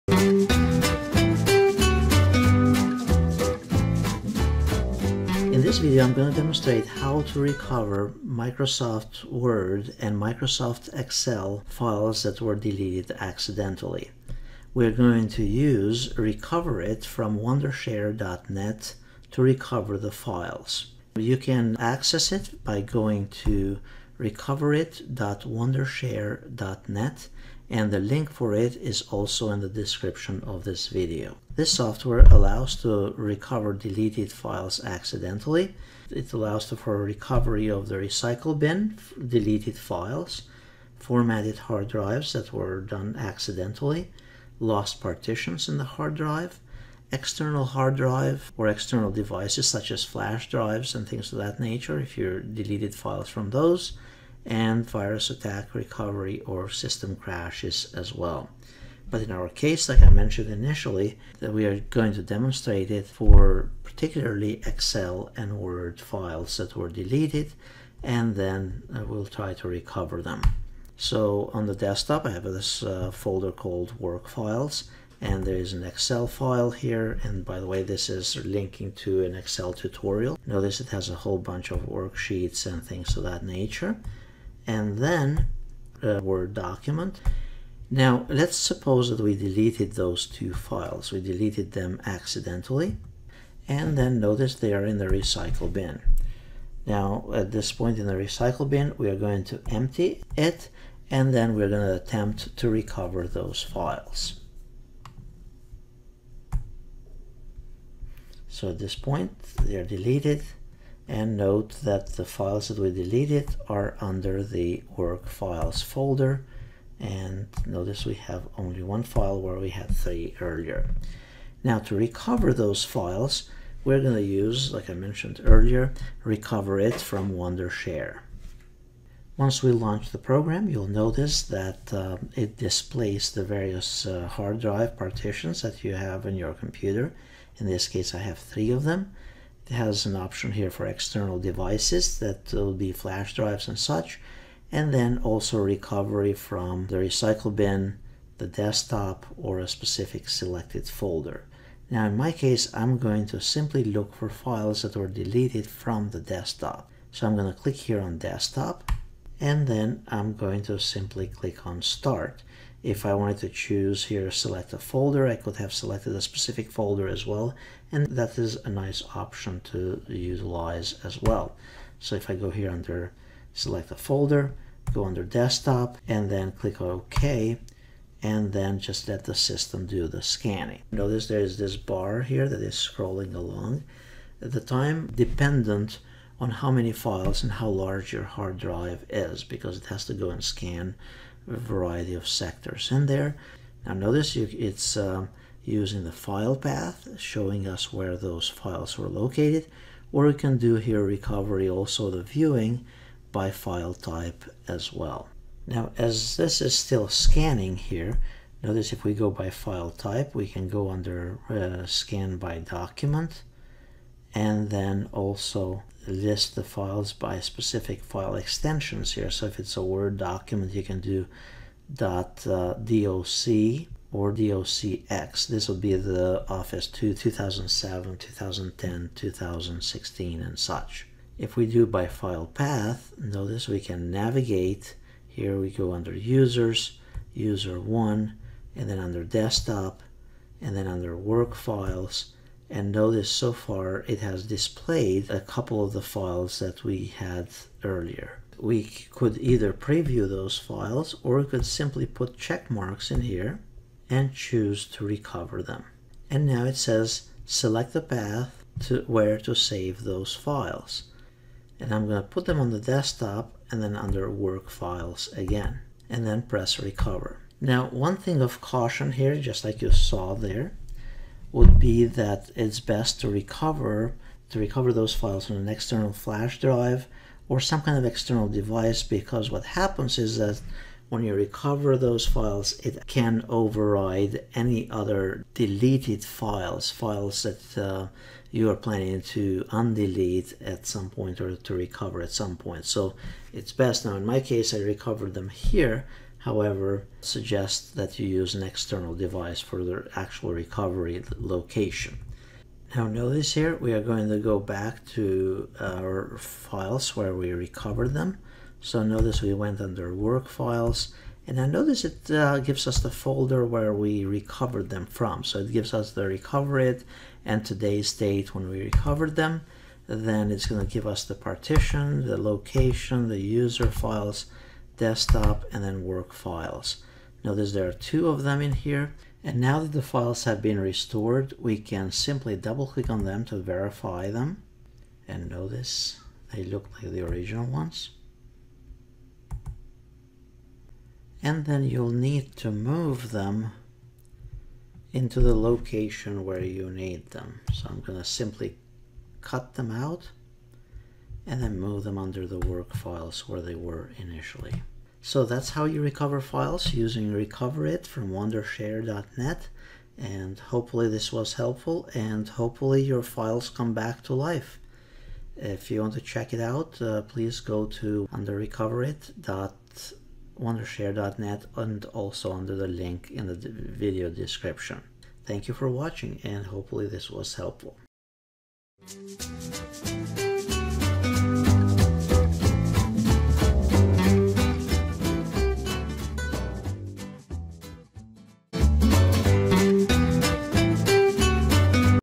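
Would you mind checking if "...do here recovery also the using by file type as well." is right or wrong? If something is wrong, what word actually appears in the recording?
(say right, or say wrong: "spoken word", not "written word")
wrong: "viewing", not "using".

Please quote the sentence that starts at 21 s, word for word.
You can access it by going to recoverit.wondershare.net and the link for it is also in the description of this video.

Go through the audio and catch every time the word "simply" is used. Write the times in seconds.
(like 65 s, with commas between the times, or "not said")
153 s, 160 s, 251 s, 332 s, 348 s.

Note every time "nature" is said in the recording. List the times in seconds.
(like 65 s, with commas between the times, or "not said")
51 s, 83 s.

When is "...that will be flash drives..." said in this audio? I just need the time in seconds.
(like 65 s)
142 s.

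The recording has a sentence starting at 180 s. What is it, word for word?
Notice there is this bar here that is scrolling along.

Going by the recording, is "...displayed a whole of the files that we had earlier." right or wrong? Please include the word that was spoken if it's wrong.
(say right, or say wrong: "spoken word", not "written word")
wrong: "couple", not "whole".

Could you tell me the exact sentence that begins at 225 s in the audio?
This will be the Office 2, 2007, 2010, 2016 and such.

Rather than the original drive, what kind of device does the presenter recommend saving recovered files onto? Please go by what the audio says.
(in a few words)
External flash drive.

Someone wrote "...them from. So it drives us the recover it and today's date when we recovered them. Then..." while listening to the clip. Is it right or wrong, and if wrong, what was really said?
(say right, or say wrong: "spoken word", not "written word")
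wrong: "gives", not "drives".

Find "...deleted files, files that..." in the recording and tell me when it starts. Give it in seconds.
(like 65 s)
285 s.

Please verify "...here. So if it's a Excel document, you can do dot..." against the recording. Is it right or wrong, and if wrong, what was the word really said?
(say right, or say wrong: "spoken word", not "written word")
wrong: "Word", not "Excel".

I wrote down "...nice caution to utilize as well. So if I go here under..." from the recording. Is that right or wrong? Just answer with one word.
wrong.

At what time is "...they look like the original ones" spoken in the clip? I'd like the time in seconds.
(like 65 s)
336 s.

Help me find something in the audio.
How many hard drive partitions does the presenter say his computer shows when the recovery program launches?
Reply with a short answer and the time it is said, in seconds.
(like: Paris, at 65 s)
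3, at 138 s.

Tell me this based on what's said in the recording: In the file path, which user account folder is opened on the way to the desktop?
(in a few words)
user one.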